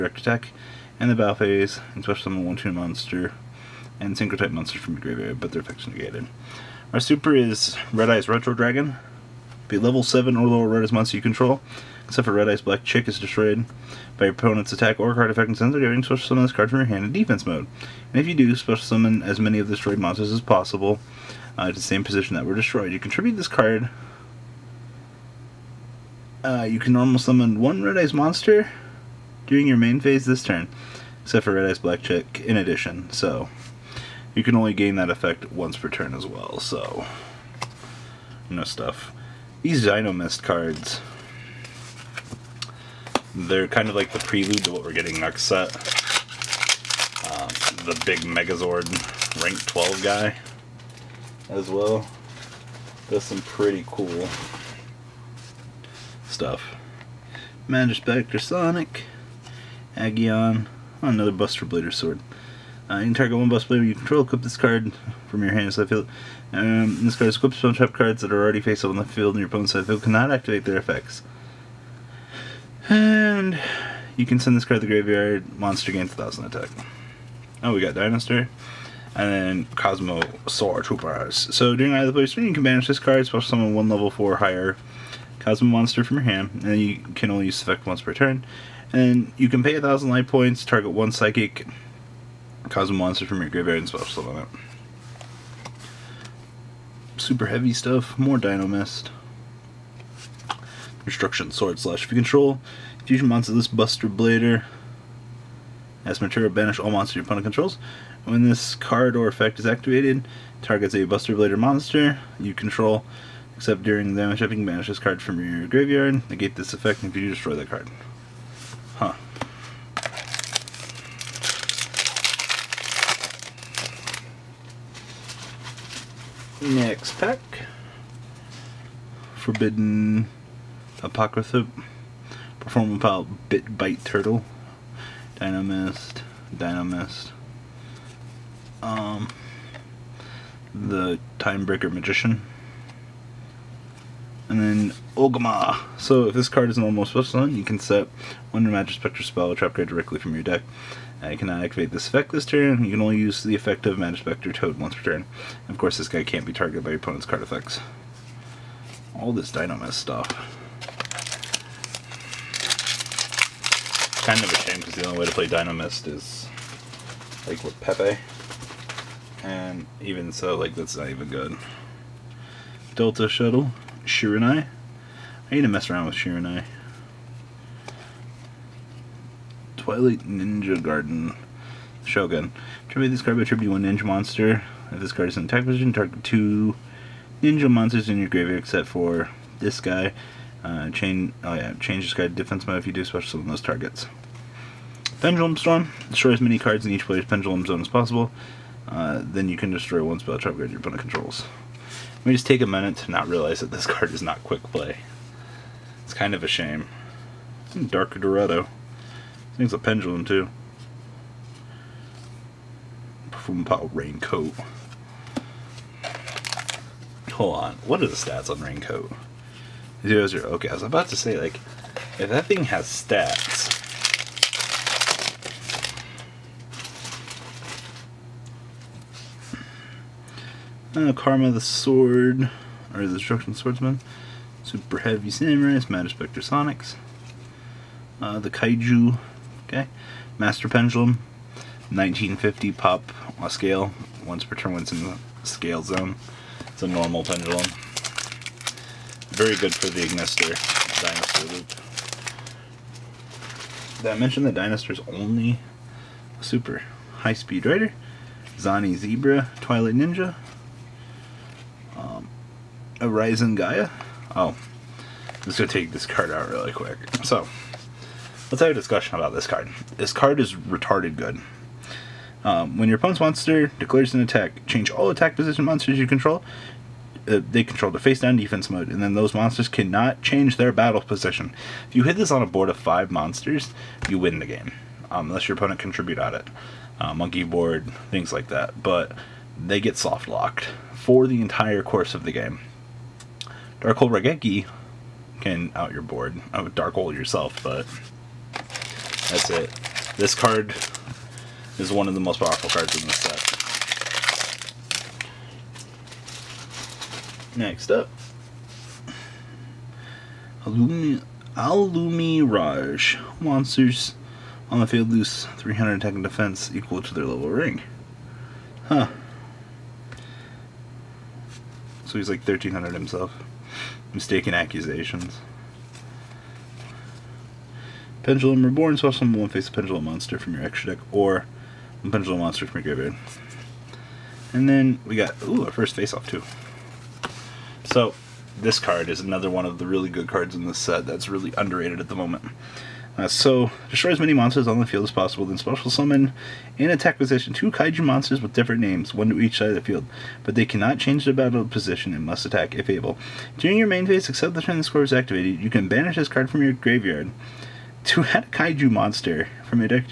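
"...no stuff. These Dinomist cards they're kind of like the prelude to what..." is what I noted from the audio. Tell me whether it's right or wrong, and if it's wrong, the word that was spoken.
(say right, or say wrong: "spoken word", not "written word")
right.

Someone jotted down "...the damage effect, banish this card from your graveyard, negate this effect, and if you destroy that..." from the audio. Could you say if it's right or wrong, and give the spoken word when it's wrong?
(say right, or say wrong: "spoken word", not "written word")
right.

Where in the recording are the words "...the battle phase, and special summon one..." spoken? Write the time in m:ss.
0:01.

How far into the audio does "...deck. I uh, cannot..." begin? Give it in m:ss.
2:30.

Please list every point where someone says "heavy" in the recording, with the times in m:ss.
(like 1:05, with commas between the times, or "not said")
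1:37, 3:54.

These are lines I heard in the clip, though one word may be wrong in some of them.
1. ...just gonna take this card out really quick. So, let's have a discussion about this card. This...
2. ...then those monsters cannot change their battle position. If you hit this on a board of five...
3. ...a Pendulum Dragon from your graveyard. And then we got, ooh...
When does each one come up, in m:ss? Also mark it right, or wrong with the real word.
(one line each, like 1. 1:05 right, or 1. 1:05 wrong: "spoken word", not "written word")
1. 4:25 right
2. 4:39 right
3. 5:32 wrong: "Monster", not "Dragon".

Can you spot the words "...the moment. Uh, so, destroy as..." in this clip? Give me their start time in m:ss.
5:42.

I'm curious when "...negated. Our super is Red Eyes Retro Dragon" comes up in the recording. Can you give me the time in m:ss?
0:05.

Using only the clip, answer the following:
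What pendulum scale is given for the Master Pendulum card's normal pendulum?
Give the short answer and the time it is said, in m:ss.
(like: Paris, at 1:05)
1950, at 4:01.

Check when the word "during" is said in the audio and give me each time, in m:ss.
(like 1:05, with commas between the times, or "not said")
0:29, 1:21, 1:53, 5:53.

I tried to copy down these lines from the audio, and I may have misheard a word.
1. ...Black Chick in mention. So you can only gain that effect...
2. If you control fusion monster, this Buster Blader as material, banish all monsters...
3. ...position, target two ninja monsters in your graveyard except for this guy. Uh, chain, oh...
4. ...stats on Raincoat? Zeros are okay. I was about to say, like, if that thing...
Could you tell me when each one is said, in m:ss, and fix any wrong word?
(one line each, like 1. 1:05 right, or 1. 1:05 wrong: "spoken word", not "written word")
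1. 0:31 wrong: "addition", not "mention"
2. 1:42 right
3. 3:05 right
4. 3:38 right.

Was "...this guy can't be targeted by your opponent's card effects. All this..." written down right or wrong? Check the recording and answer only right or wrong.
right.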